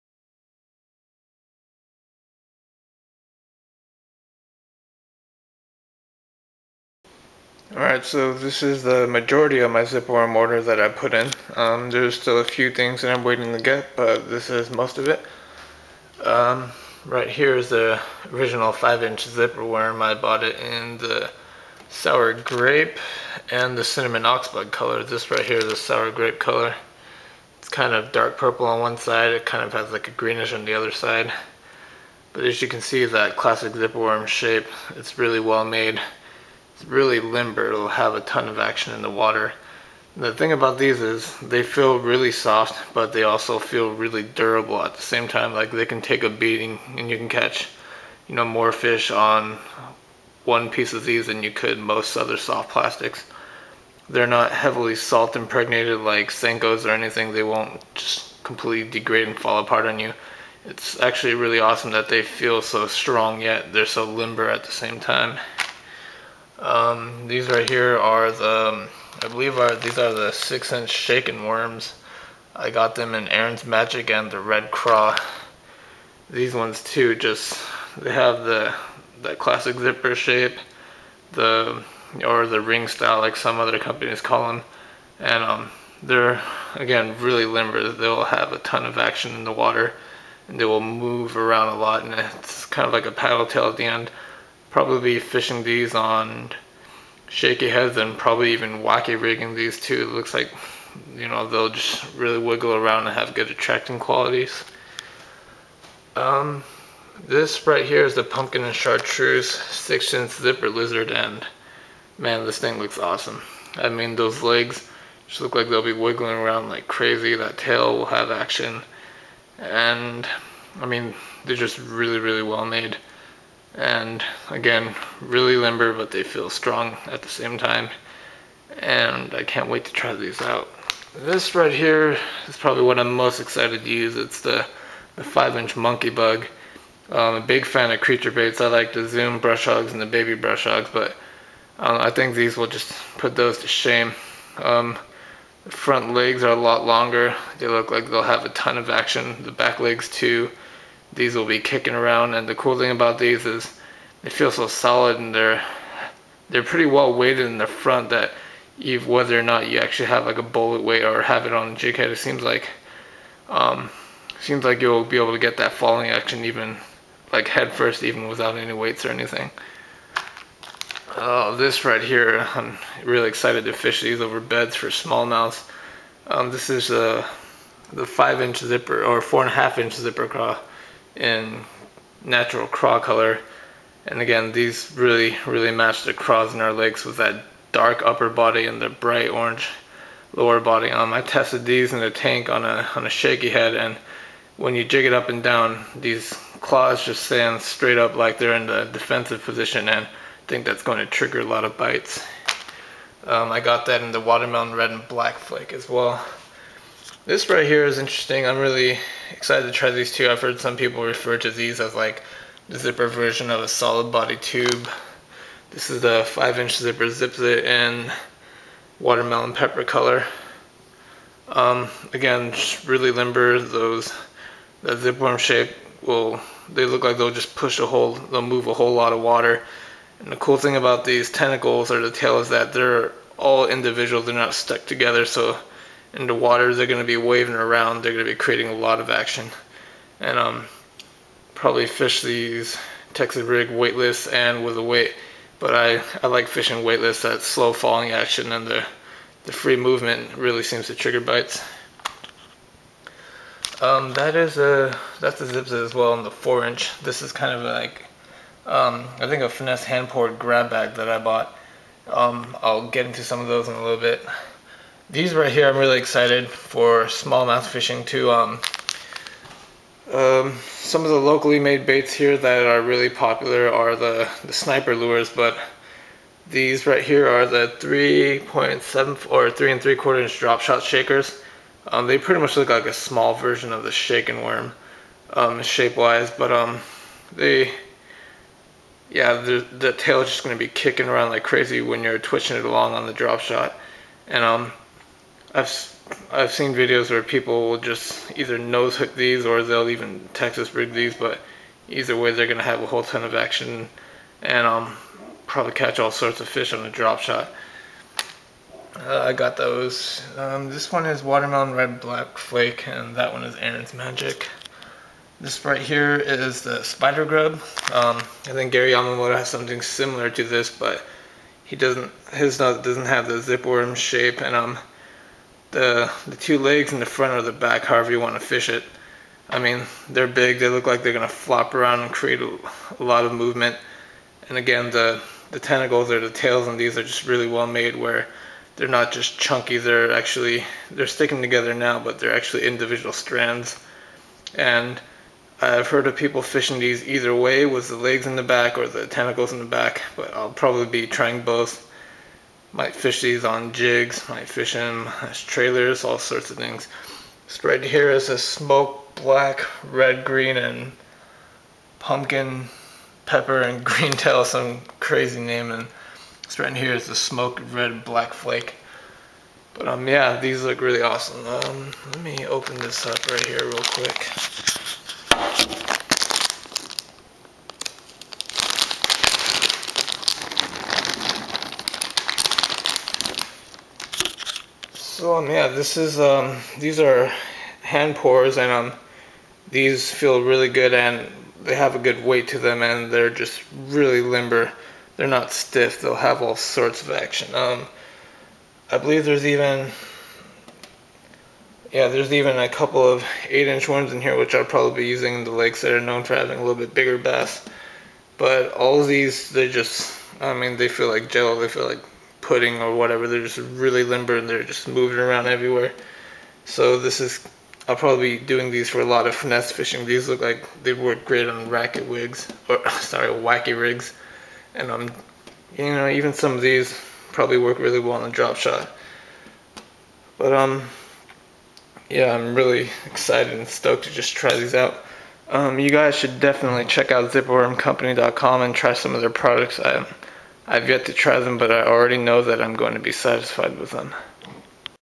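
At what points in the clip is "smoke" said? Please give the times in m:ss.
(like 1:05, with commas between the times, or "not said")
5:58, 6:07.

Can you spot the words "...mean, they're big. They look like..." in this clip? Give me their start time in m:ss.
5:29.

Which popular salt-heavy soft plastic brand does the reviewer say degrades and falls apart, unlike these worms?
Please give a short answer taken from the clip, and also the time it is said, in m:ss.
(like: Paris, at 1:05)
Senkos, at 0:56.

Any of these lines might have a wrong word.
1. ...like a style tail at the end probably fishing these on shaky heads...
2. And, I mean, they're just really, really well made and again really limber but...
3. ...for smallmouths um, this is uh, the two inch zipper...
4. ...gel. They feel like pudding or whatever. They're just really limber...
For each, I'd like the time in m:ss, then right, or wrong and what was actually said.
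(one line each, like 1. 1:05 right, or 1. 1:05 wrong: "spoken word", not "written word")
1. 1:32 wrong: "paddle", not "style"
2. 1:59 right
3. 2:54 wrong: "five", not "two"
4. 6:51 right.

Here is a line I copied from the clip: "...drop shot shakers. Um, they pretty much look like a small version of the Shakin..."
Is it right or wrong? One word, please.
right.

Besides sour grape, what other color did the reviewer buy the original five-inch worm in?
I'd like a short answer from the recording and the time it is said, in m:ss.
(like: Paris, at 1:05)
Cinnamon oxblood, at 0:23.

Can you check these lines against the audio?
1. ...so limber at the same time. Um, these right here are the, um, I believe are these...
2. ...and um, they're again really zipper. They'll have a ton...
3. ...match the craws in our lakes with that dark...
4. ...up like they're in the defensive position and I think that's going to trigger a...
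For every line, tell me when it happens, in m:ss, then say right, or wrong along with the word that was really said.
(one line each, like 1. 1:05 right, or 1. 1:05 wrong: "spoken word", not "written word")
1. 1:03 right
2. 1:25 wrong: "limber", not "zipper"
3. 3:05 right
4. 3:17 right.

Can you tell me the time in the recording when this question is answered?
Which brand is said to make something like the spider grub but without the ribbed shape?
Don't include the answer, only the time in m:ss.
5:18.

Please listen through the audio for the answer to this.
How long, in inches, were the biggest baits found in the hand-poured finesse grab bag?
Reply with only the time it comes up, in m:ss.
6:43.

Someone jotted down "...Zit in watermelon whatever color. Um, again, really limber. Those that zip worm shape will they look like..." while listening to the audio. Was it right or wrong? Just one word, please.
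wrong.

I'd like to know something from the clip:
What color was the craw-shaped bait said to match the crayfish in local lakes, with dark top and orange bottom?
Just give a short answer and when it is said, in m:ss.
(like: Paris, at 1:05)
Natural craw, at 3:02.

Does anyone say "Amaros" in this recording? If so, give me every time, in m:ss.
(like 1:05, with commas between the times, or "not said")
not said.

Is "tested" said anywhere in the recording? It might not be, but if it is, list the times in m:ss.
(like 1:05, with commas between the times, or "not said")
3:11.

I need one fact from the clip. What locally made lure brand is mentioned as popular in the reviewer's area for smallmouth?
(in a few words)
Sniper lures.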